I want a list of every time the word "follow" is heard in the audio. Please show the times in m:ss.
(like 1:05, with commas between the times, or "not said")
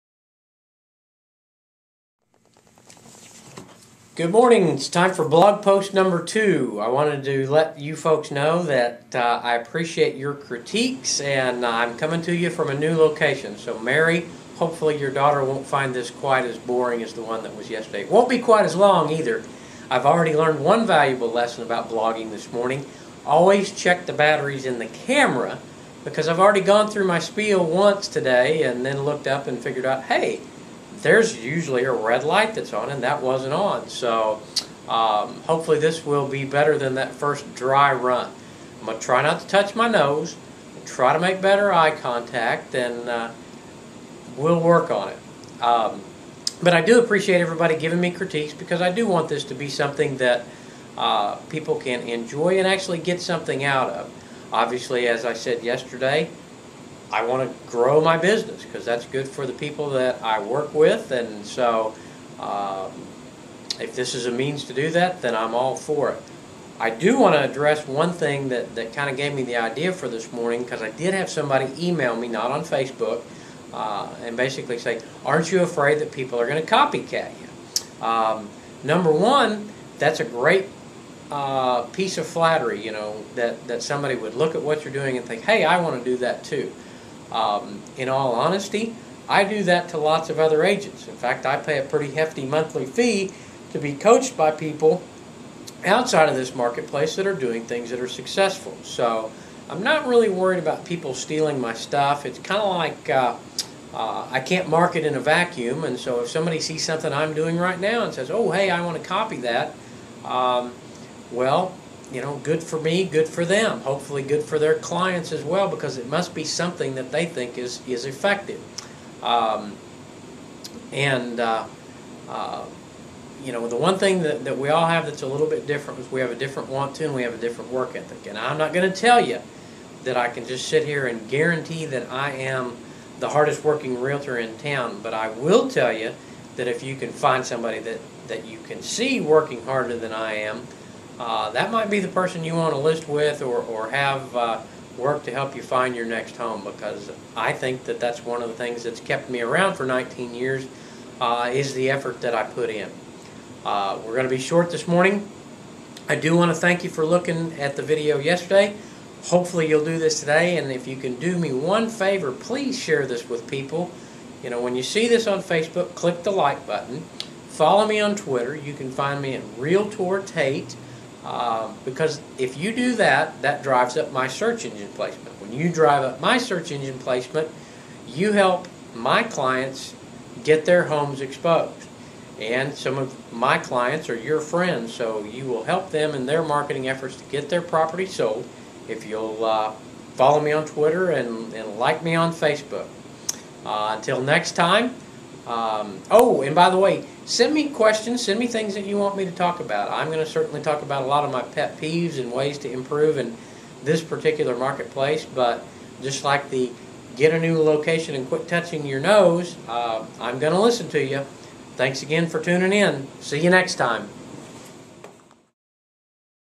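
2:47, 3:10.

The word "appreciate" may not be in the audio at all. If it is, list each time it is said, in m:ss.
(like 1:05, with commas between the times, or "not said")
0:09, 0:46.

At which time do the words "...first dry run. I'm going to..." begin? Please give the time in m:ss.
0:37.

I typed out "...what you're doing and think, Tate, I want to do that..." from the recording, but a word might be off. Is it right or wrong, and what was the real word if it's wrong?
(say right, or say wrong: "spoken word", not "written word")
wrong: "Hey", not "Tate".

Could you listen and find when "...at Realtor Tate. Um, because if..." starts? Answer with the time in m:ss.
2:49.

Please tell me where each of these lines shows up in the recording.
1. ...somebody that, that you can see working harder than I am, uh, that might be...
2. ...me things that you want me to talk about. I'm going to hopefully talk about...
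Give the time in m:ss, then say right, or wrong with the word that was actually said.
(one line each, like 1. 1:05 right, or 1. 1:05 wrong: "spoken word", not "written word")
1. 2:17 right
2. 3:18 wrong: "certainly", not "hopefully".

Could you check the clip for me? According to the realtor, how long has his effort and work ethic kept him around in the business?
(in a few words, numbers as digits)
19 years.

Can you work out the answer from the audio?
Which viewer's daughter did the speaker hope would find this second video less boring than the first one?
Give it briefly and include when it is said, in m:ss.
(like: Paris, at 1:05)
Mary, at 0:13.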